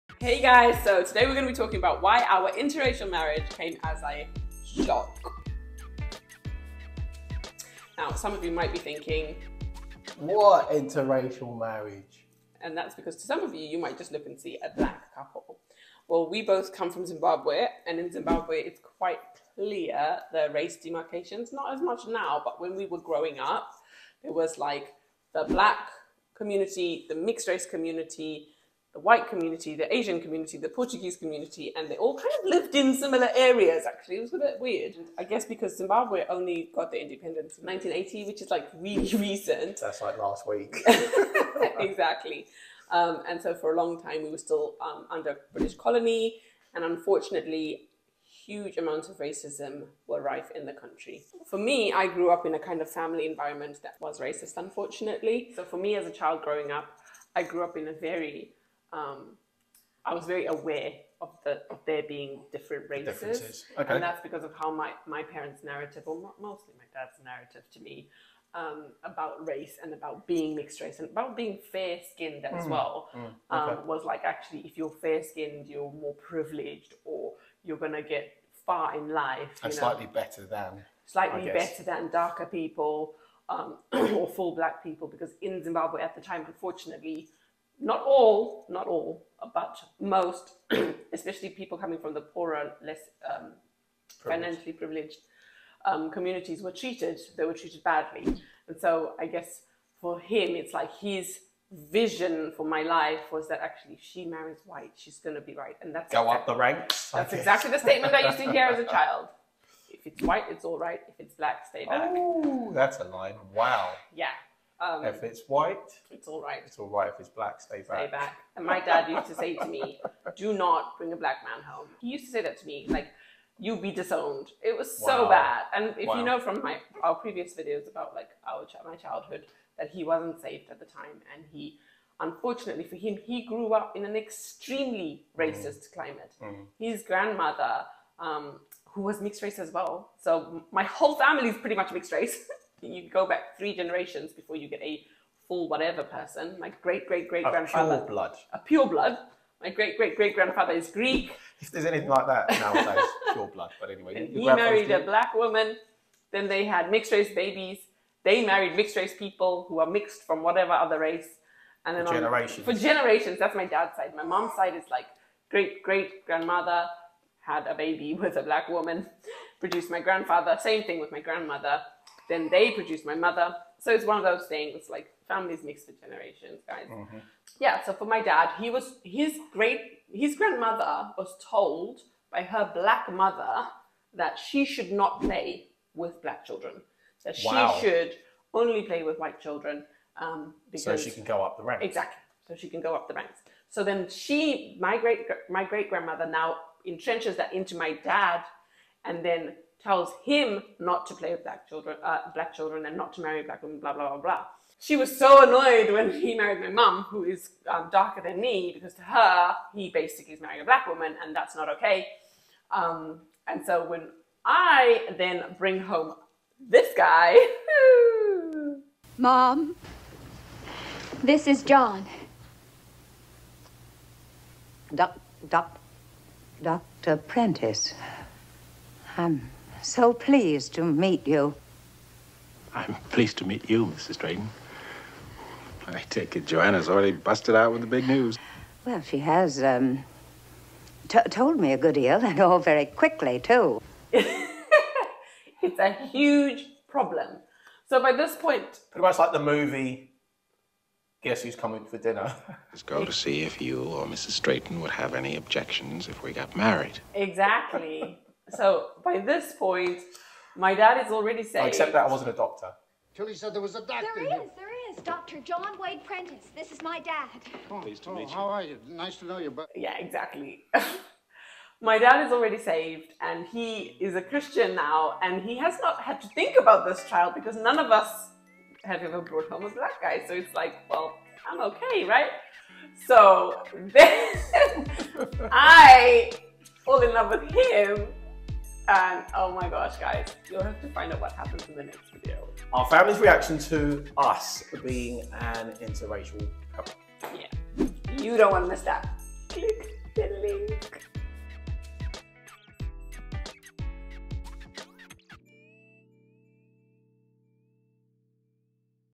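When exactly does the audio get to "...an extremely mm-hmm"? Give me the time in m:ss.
2:14.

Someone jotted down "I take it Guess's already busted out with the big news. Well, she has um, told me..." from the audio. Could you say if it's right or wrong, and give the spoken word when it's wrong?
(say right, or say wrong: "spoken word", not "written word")
wrong: "Joanna", not "Guess".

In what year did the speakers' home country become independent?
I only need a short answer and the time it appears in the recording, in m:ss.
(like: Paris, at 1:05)
1980, at 0:37.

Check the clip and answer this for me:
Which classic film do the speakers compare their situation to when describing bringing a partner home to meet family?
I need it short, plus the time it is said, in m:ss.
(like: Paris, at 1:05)
Guess Who's Coming for Dinner, at 4:11.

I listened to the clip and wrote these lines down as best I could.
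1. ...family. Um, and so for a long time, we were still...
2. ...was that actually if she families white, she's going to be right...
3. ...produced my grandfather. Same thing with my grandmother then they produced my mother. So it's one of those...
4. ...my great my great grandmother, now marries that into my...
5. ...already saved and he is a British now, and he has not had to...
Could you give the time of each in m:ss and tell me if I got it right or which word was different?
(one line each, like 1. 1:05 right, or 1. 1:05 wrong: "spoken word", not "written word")
1. 0:41 wrong: "exactly", not "family"
2. 1:43 wrong: "marries", not "families"
3. 2:49 right
4. 3:14 wrong: "entrenches", not "marries"
5. 4:32 wrong: "Christian", not "British".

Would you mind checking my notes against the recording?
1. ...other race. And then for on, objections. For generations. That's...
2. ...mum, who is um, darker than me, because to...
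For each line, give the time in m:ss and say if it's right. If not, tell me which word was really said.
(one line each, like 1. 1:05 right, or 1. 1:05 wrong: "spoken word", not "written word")
1. 2:40 wrong: "generations", not "objections"
2. 3:26 right.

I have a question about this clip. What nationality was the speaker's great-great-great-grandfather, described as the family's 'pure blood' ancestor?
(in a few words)
Greek.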